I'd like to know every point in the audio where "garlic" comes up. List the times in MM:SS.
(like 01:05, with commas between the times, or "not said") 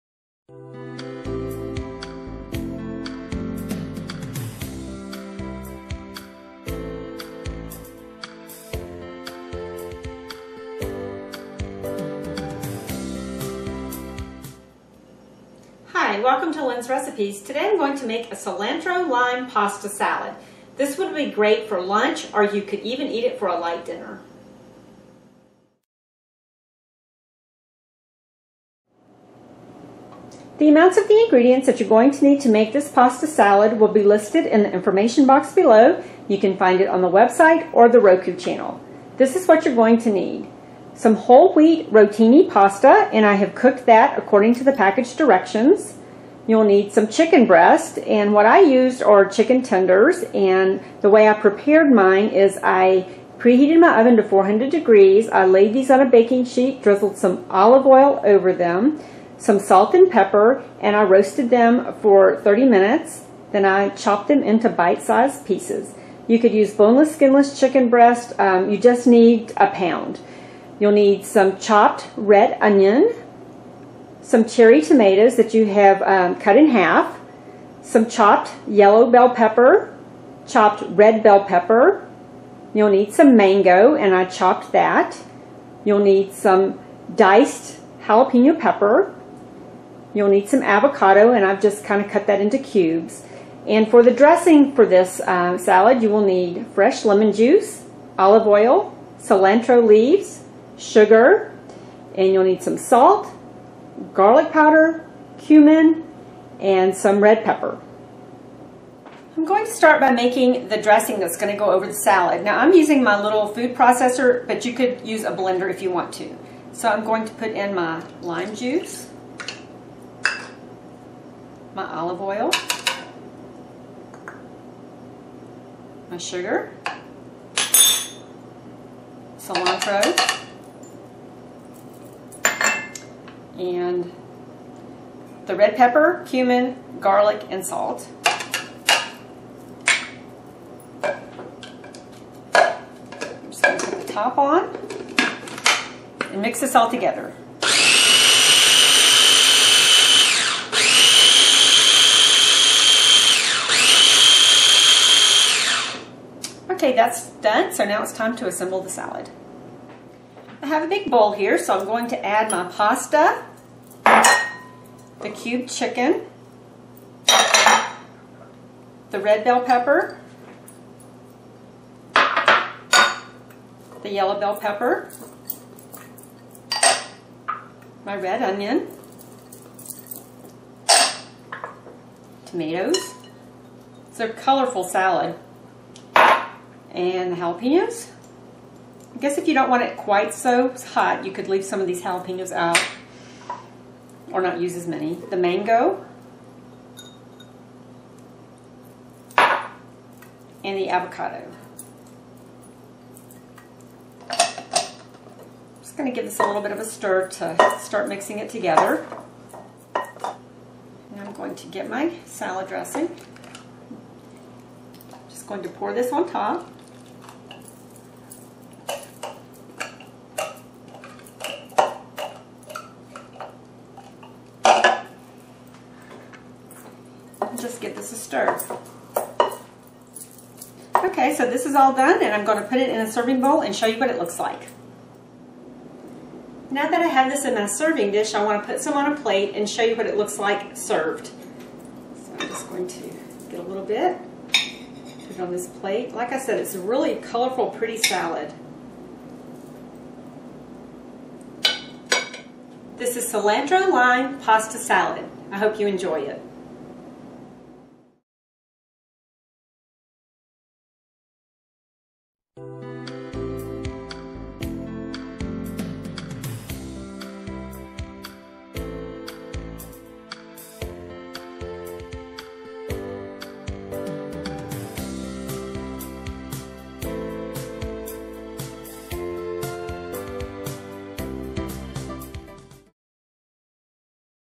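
01:44, 02:16.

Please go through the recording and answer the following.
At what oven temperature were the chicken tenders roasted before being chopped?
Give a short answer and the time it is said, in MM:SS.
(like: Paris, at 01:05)
400 degrees, at 00:54.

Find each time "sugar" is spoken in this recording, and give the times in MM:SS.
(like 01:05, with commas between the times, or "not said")
01:40, 02:06.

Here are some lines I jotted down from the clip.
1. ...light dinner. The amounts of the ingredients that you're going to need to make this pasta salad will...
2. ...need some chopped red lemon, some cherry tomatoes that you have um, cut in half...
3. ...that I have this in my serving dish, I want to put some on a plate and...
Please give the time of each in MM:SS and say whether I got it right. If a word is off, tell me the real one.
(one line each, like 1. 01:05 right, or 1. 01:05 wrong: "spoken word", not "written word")
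1. 00:23 right
2. 01:10 wrong: "onion", not "lemon"
3. 03:56 right.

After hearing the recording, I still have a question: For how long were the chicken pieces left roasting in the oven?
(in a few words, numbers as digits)
30 minutes.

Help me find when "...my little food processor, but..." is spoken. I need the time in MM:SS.
01:53.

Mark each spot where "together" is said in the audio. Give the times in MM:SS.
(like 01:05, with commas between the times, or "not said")
02:26, 03:28.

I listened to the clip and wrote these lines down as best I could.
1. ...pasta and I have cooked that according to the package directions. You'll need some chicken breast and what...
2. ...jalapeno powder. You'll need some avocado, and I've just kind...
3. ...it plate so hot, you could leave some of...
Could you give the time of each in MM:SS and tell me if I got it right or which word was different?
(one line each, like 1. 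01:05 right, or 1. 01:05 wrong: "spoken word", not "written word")
1. 00:42 right
2. 01:28 wrong: "pepper", not "powder"
3. 03:09 wrong: "quite", not "plate".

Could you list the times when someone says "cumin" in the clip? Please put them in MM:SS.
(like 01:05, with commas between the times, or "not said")
01:45, 02:16.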